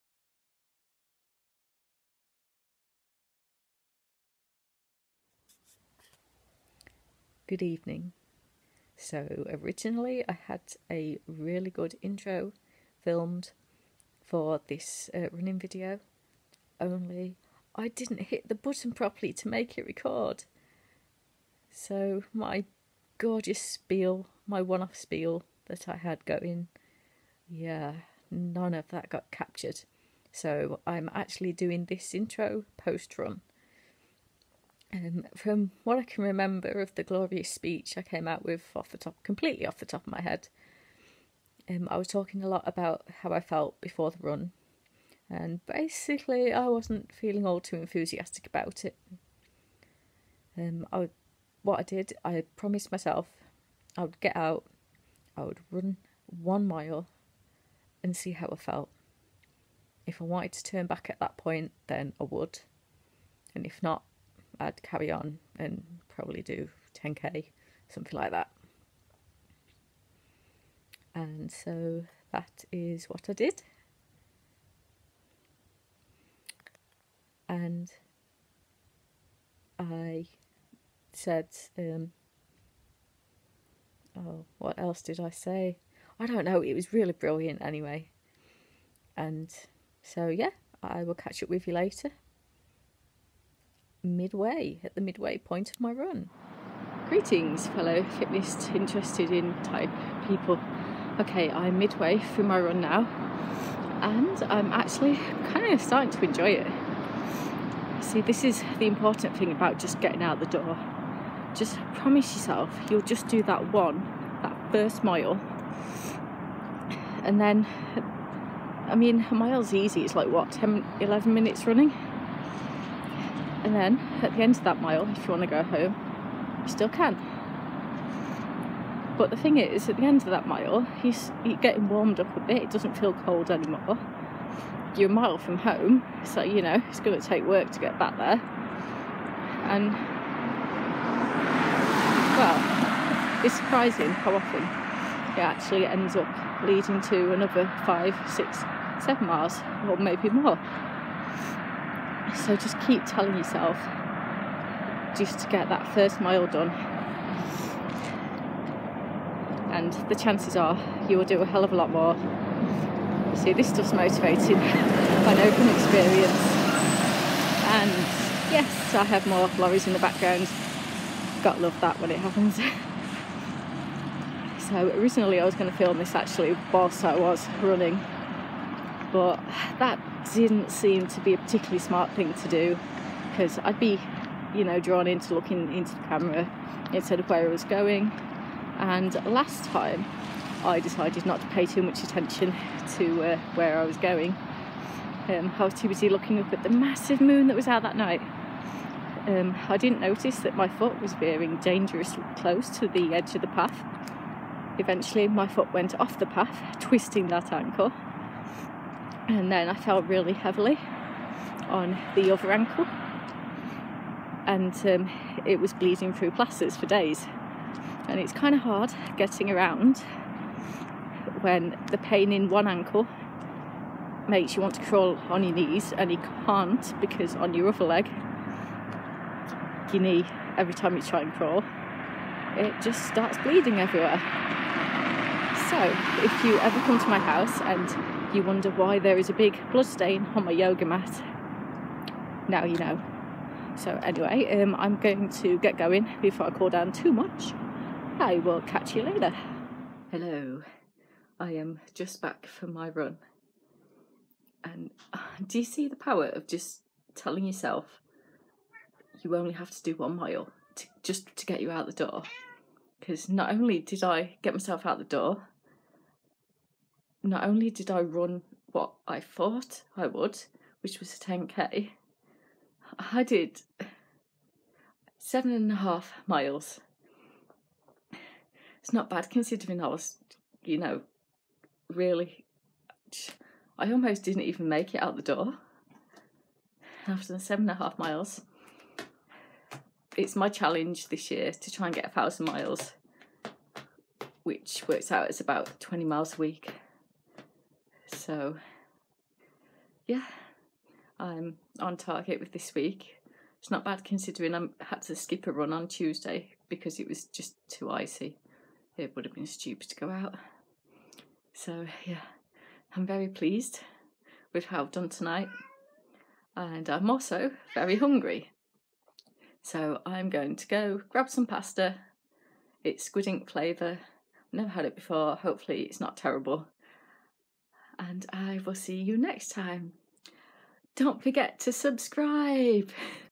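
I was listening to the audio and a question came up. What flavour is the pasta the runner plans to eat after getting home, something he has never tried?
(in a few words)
squid ink.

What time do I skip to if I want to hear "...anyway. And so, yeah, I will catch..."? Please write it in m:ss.
1:27.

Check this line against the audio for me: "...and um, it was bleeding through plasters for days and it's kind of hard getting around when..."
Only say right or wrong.
right.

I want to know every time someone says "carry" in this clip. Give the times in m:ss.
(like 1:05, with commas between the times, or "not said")
1:04.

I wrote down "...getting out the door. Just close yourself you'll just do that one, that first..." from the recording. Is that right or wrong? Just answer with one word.
wrong.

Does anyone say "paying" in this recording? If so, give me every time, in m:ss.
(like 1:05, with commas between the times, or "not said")
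not said.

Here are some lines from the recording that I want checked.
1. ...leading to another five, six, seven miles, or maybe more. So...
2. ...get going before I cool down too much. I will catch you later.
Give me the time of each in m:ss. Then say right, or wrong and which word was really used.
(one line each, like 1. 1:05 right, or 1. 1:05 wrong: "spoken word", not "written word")
1. 2:26 right
2. 4:05 right.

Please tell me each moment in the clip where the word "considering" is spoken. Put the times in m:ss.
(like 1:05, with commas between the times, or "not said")
4:39, 5:04.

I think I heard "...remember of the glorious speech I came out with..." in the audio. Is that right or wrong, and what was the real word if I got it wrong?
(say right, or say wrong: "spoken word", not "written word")
right.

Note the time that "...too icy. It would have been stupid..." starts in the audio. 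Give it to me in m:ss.
5:07.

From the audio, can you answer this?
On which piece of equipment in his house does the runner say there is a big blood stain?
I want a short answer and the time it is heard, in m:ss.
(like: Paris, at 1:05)
yoga mat, at 4:00.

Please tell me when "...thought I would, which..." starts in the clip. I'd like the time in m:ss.
4:29.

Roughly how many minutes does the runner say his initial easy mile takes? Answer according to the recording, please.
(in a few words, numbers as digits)
10, 11 minutes.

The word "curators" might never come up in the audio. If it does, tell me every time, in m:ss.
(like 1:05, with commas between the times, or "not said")
not said.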